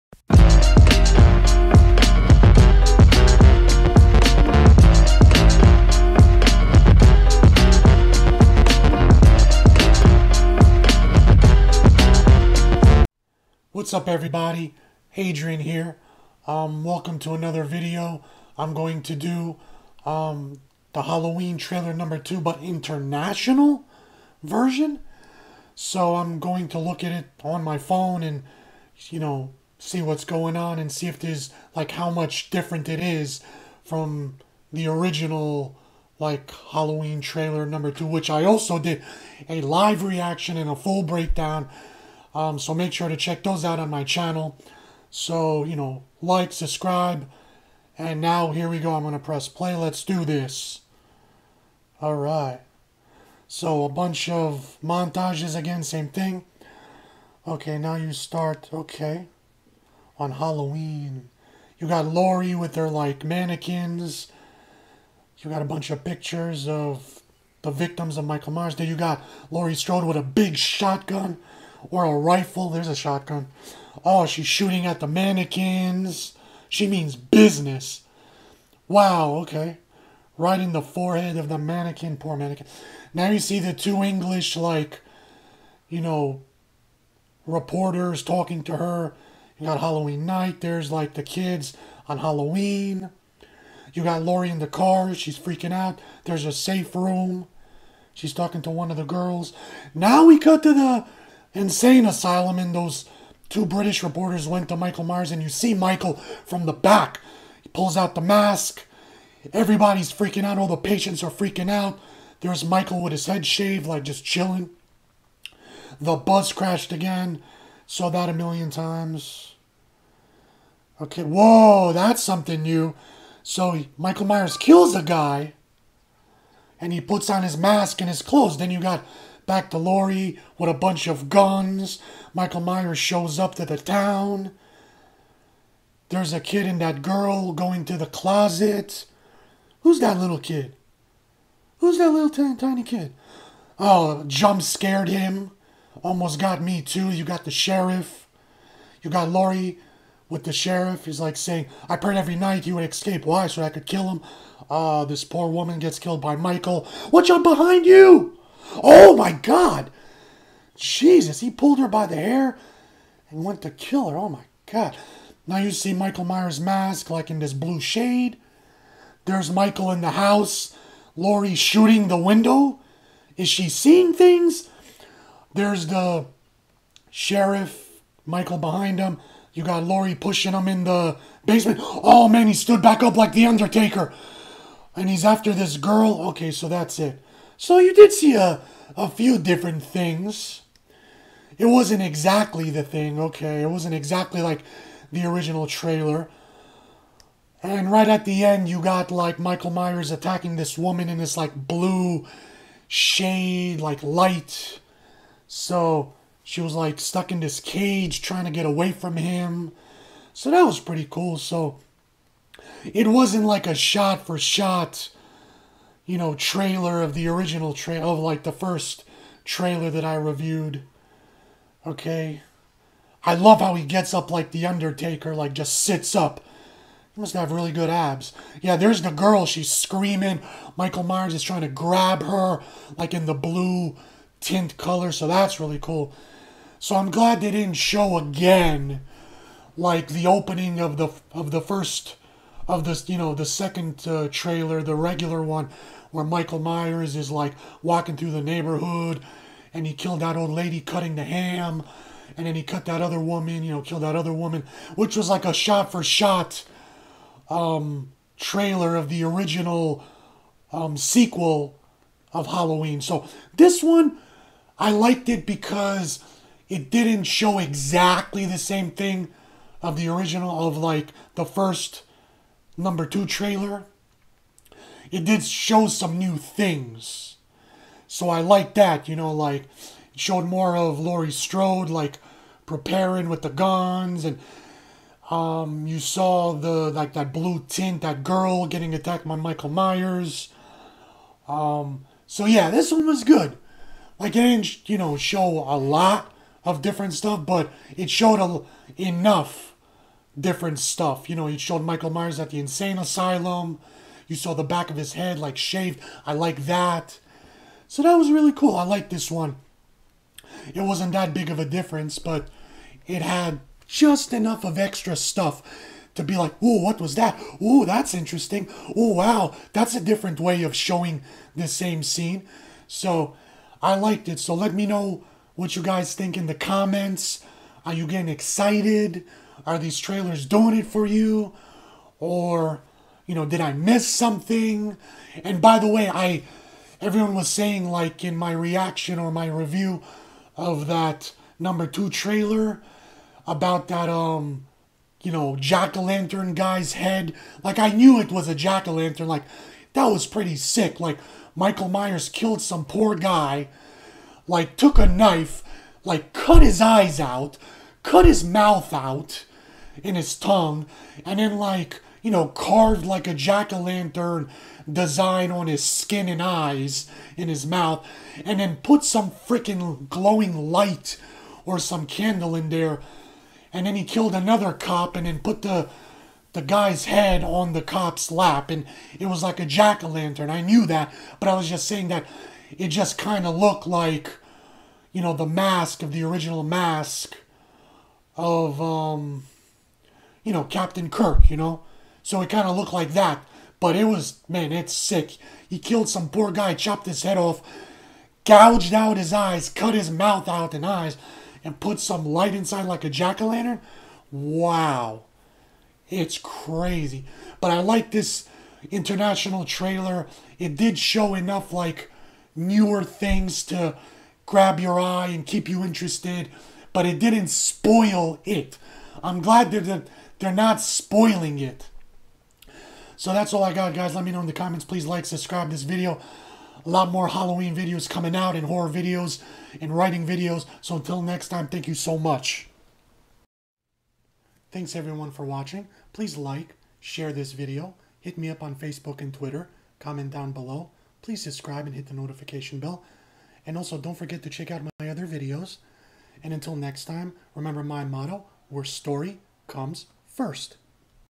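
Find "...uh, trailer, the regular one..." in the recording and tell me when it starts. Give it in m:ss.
4:04.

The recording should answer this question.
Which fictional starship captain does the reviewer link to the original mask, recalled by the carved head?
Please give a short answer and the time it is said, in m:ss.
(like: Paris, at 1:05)
Captain Kirk, at 6:30.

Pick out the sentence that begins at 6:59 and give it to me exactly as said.
I'm glad that they're not spoiling it.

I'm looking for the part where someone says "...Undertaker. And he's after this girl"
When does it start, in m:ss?
3:03.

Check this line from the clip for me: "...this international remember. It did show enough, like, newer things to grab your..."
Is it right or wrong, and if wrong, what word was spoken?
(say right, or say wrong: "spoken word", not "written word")
wrong: "trailer", not "remember".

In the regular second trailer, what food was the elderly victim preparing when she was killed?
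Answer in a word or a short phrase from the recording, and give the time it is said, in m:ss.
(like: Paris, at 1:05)
ham, at 4:11.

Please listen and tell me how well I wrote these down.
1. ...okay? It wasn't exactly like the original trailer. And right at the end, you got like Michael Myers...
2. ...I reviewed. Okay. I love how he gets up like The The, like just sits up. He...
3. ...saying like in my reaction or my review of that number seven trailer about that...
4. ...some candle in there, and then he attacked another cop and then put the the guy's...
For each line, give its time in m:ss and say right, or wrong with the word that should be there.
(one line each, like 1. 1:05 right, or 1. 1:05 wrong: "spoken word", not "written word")
1. 3:13 right
2. 3:40 wrong: "Undertaker", not "The"
3. 5:37 wrong: "two", not "seven"
4. 6:11 wrong: "killed", not "attacked".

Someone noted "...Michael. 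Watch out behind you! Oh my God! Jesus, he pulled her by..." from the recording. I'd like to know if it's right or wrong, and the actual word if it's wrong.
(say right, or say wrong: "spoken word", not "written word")
right.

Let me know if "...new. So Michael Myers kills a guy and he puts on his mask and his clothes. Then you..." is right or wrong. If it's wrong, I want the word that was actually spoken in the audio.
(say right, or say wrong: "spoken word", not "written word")
right.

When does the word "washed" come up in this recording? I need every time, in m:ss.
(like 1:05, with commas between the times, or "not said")
not said.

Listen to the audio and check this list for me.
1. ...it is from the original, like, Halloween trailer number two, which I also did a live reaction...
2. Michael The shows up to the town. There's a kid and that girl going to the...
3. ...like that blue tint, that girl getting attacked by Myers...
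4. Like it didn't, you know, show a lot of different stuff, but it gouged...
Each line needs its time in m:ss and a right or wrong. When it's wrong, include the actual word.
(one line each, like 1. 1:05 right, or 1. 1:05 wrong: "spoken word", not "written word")
1. 0:32 right
2. 2:12 wrong: "Myers", not "The"
3. 4:46 wrong: "Michael", not "Myers"
4. 4:54 wrong: "showed", not "gouged".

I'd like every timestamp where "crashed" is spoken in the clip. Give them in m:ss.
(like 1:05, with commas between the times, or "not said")
1:56.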